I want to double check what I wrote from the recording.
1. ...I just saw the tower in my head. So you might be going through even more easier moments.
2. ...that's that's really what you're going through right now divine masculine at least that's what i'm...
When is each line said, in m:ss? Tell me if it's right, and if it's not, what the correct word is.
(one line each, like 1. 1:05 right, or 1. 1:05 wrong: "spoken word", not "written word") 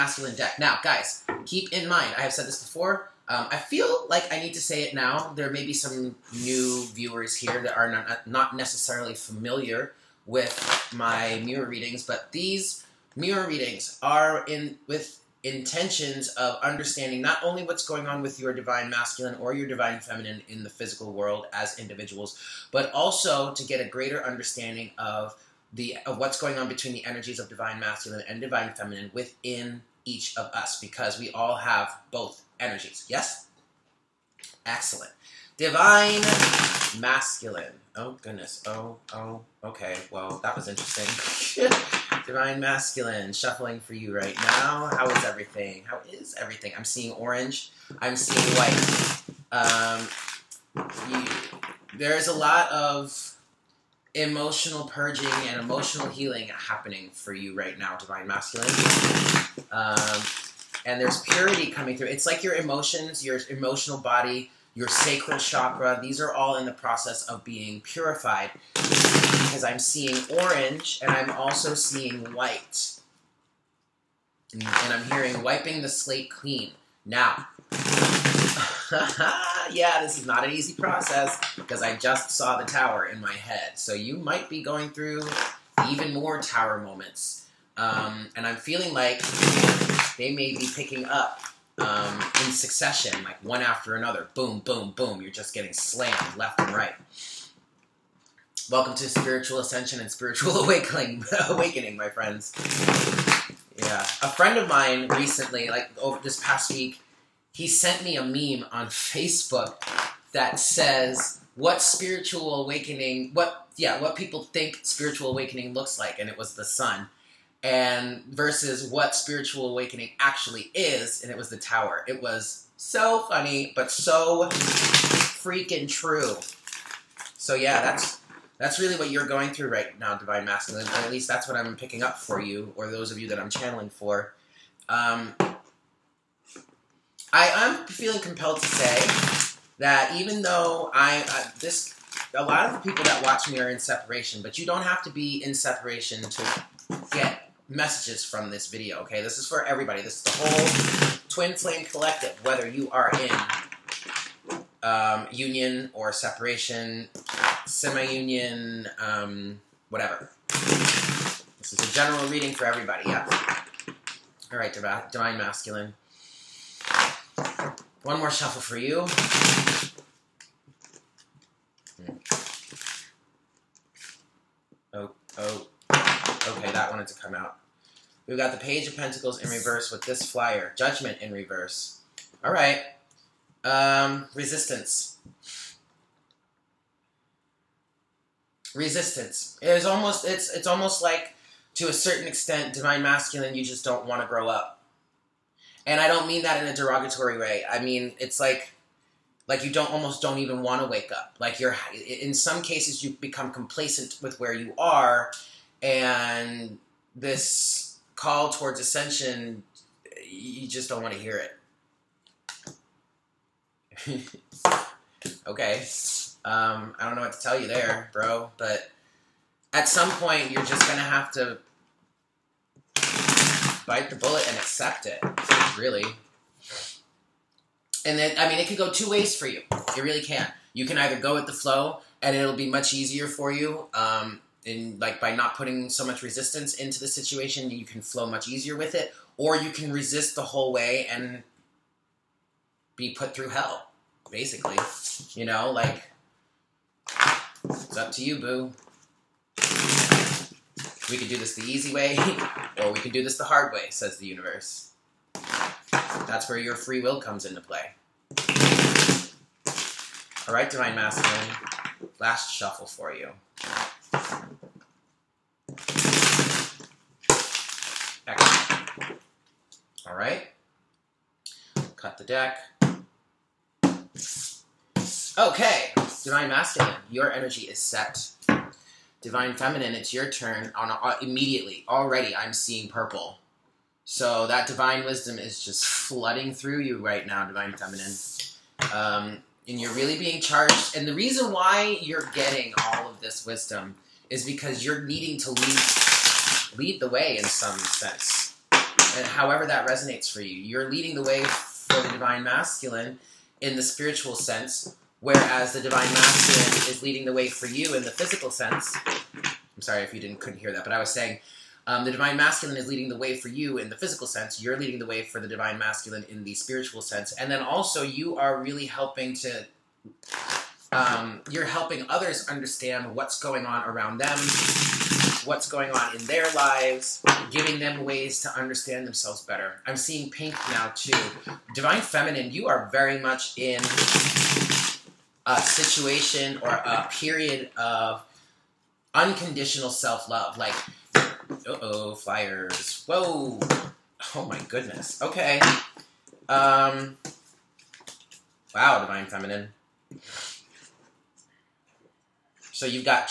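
1. 1:21 wrong: "tower", not "easier"
2. 2:07 right.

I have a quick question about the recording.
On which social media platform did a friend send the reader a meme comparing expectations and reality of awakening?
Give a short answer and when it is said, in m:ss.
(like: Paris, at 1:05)
Facebook, at 1:48.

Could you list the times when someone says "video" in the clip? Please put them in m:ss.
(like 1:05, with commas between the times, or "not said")
2:28.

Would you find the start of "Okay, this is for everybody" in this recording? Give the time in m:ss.
2:28.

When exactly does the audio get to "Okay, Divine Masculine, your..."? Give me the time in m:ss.
4:35.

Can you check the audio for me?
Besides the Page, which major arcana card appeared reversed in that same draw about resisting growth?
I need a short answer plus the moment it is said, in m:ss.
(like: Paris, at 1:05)
Judgment, at 3:00.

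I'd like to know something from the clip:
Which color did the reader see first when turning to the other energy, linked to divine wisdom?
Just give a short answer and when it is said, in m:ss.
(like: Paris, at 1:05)
Purple, at 4:42.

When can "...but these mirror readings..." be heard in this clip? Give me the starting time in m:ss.
0:12.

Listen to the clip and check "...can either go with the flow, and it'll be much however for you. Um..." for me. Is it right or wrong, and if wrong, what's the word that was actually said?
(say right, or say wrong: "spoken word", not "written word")
wrong: "easier", not "however".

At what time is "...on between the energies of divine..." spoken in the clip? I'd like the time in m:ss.
0:26.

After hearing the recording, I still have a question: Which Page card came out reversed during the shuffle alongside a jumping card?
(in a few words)
Page of Pentacles.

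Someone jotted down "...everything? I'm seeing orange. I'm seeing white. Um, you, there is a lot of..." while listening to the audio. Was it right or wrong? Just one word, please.
right.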